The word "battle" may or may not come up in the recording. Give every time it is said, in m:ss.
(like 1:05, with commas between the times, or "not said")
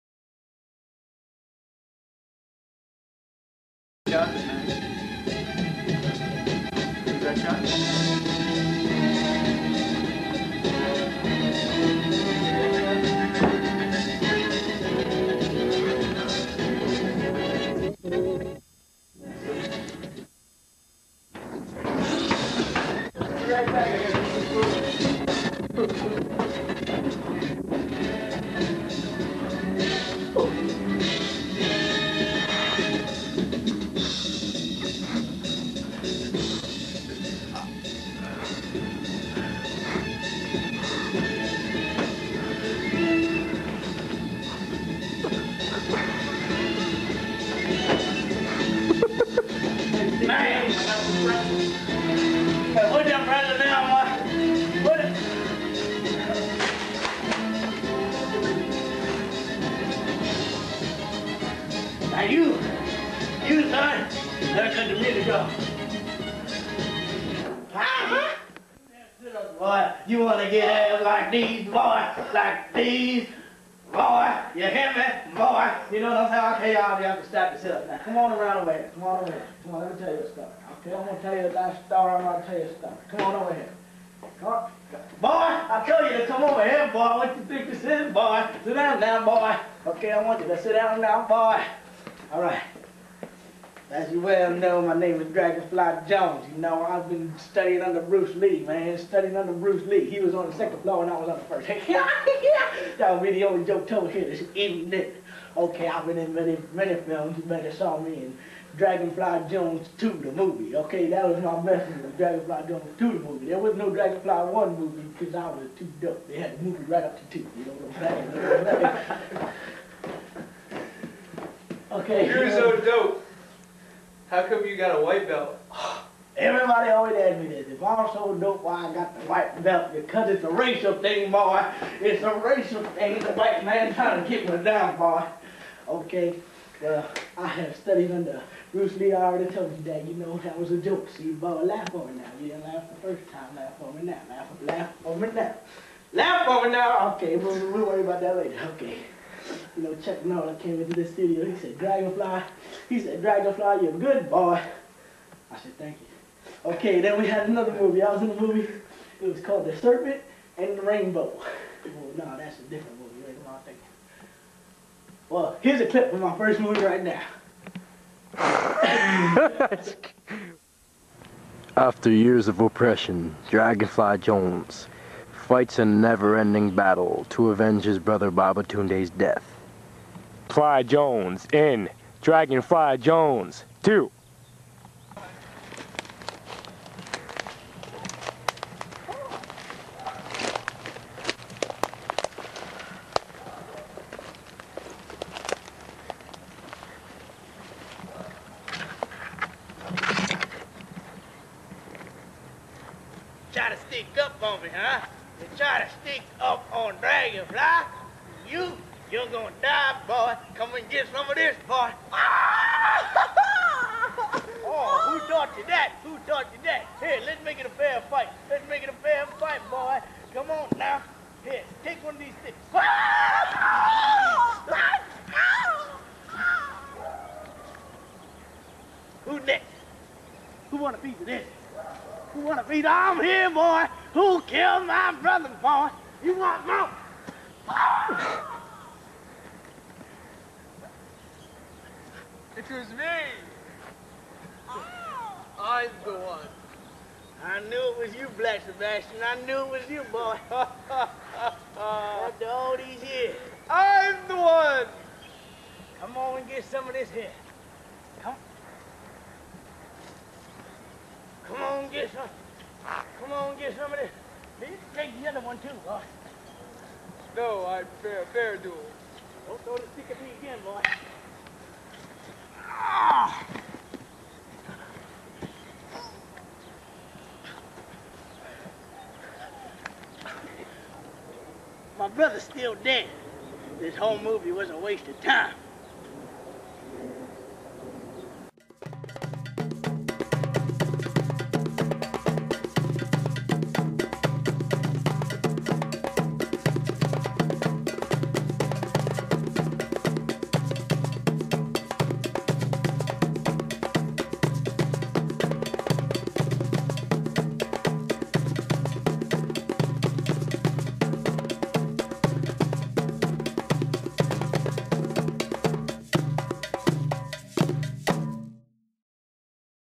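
2:56.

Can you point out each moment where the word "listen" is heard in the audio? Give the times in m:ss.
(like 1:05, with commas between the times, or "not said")
not said.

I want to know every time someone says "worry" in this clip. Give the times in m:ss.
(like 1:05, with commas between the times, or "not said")
2:27.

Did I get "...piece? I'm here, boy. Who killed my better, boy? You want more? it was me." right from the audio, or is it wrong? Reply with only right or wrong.
wrong.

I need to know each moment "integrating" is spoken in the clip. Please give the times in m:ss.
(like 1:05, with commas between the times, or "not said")
not said.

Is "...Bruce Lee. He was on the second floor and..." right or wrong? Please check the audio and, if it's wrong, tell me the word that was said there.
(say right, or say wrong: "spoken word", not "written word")
right.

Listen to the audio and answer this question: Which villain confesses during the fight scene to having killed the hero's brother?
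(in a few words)
Black Sebastian.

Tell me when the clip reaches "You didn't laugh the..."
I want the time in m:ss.
2:22.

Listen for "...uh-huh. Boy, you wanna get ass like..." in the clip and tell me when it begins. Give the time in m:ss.
1:07.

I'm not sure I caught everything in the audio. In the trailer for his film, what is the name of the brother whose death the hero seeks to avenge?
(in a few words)
Babatunde.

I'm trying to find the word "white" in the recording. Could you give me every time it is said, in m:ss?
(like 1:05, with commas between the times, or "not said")
2:05, 2:09, 2:13.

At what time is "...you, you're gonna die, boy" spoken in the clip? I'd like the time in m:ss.
3:28.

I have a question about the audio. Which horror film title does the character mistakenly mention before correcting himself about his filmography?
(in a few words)
The Serpent and the Rainbow.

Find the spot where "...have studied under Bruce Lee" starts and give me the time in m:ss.
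2:17.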